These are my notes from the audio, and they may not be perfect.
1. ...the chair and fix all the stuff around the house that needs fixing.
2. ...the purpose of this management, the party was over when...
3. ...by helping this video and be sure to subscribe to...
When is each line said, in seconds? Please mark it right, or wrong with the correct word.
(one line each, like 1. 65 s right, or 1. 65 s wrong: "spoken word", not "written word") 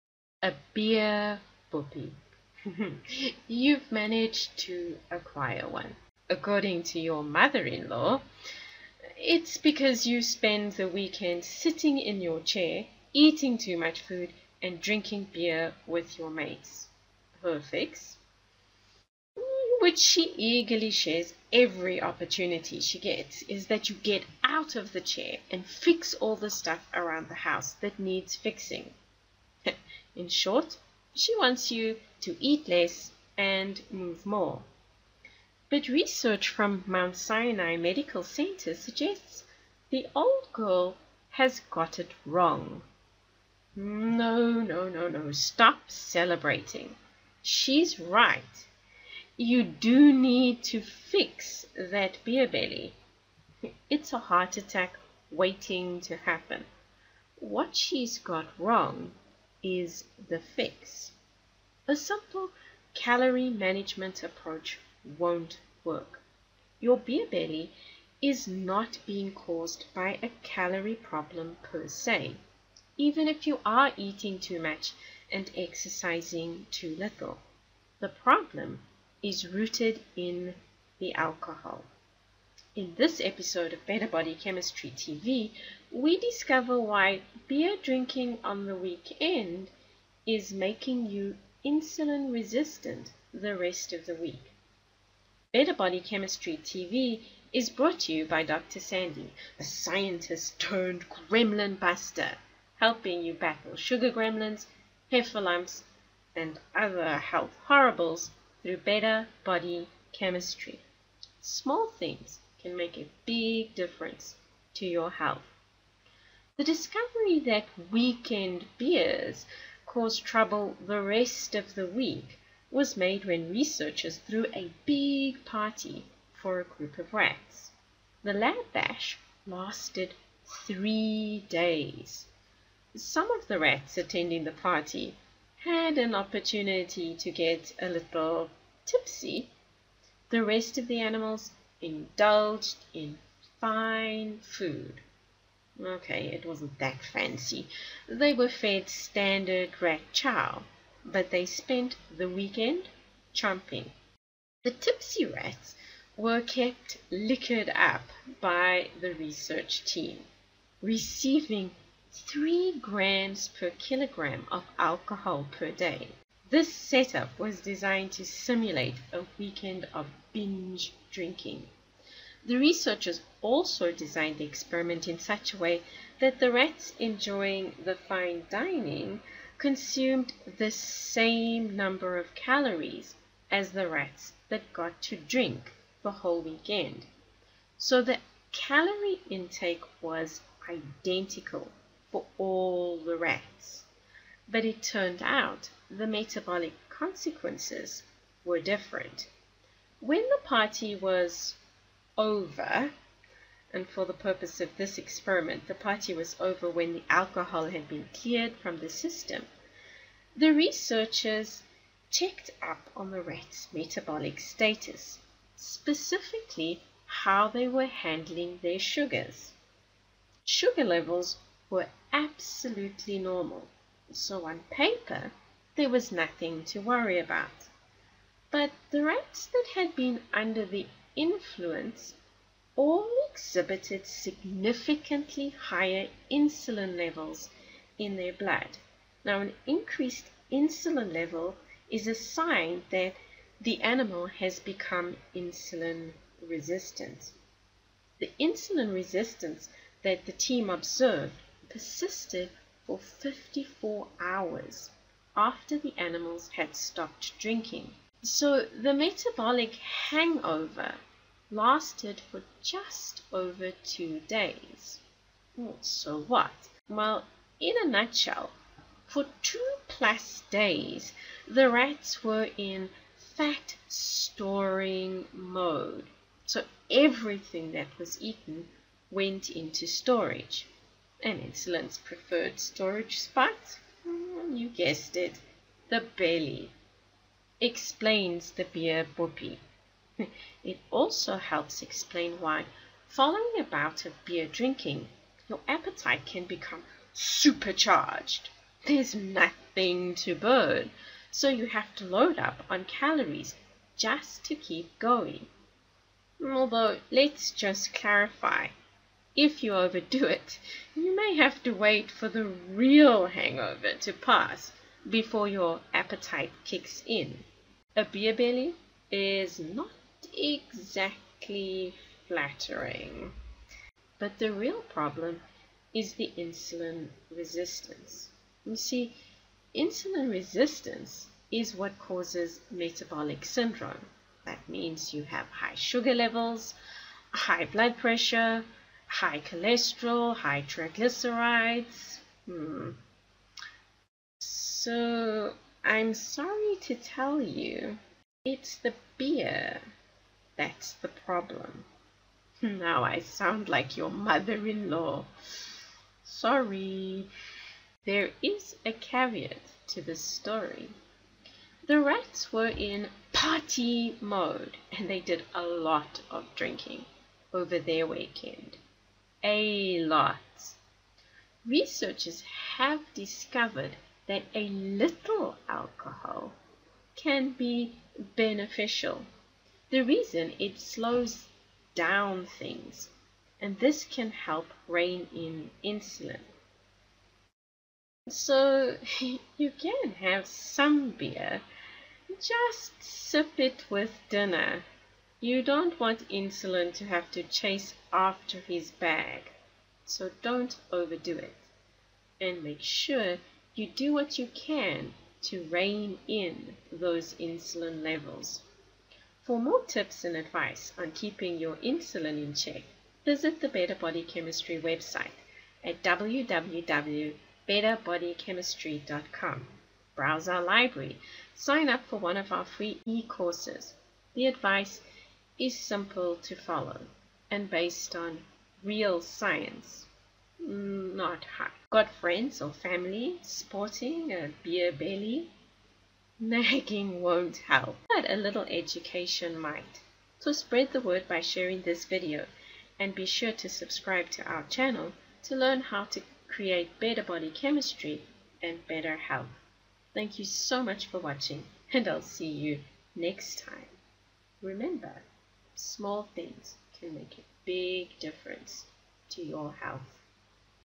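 1. 24 s right
2. 204 s wrong: "experiment", not "management"
3. 441 s wrong: "sharing", not "helping".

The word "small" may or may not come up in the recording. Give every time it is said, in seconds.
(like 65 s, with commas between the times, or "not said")
111 s, 455 s.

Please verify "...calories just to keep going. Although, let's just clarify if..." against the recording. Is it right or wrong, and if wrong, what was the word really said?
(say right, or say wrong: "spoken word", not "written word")
right.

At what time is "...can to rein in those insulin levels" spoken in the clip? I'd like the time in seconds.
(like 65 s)
404 s.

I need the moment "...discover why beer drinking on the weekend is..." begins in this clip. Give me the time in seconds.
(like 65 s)
86 s.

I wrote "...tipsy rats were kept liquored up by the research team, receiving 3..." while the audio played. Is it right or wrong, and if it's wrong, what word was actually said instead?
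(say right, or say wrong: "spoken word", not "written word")
right.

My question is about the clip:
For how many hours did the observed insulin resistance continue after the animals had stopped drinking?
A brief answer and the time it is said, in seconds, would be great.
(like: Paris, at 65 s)
54, at 252 s.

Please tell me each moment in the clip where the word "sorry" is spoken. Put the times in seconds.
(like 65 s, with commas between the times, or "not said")
346 s, 356 s.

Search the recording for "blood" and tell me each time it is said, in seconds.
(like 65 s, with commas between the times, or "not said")
238 s, 337 s.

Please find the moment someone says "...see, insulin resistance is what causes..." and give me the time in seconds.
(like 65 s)
328 s.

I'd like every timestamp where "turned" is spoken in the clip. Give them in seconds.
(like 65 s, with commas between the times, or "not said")
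100 s, 194 s.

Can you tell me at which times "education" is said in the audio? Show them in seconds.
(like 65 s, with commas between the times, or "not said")
438 s.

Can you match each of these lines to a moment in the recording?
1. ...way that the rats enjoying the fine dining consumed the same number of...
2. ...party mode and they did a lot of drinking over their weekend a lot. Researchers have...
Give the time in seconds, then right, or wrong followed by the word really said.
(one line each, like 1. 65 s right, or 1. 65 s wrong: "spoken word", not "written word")
1. 175 s right
2. 363 s right.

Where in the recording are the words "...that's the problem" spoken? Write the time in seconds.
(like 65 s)
350 s.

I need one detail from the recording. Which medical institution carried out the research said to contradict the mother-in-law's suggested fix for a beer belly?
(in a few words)
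Mount Sinai Medical Center.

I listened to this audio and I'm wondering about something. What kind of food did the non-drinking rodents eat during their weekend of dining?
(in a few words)
standard rat chow.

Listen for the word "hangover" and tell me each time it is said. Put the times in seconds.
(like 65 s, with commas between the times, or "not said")
259 s, 313 s.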